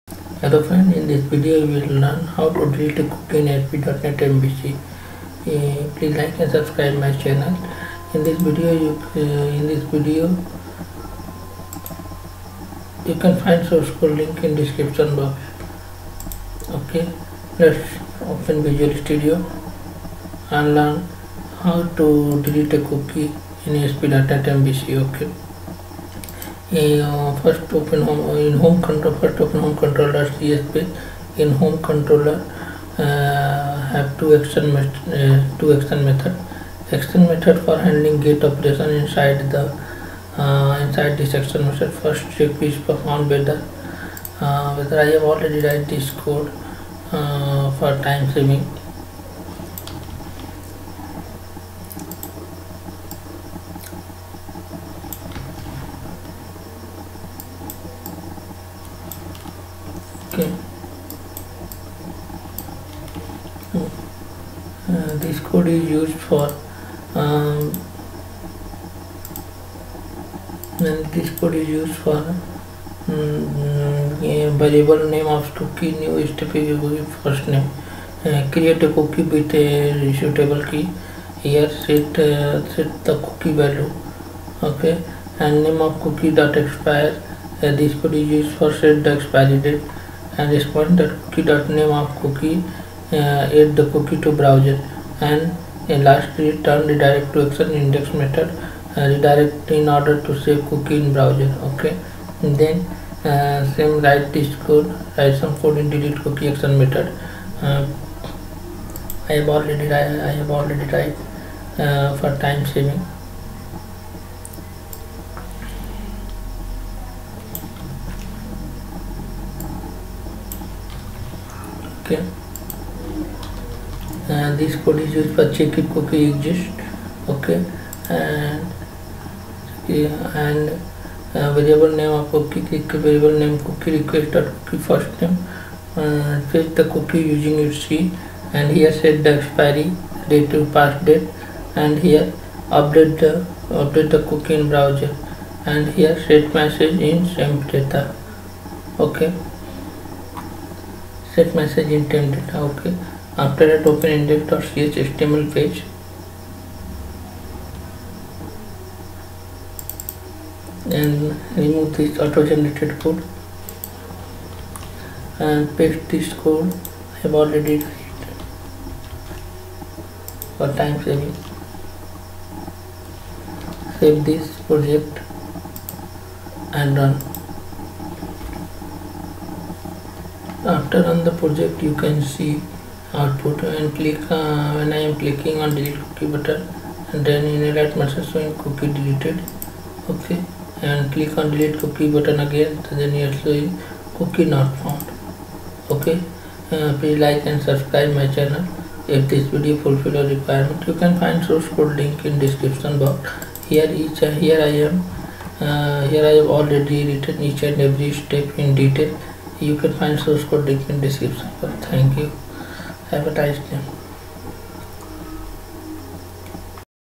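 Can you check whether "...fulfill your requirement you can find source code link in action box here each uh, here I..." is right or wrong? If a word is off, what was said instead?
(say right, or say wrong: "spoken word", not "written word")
wrong: "description", not "action".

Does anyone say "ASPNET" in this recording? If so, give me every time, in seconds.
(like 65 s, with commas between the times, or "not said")
3 s, 23 s.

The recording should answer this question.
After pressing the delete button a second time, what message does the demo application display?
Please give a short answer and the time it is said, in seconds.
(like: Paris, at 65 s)
cookie not found, at 194 s.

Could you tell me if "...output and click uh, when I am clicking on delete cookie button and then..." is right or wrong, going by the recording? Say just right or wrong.
right.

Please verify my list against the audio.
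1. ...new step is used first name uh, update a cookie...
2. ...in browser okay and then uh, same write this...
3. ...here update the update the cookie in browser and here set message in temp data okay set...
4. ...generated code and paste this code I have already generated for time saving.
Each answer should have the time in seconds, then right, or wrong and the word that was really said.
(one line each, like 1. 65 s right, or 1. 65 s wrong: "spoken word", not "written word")
1. 75 s wrong: "create", not "update"
2. 100 s right
3. 142 s right
4. 162 s wrong: "created", not "generated".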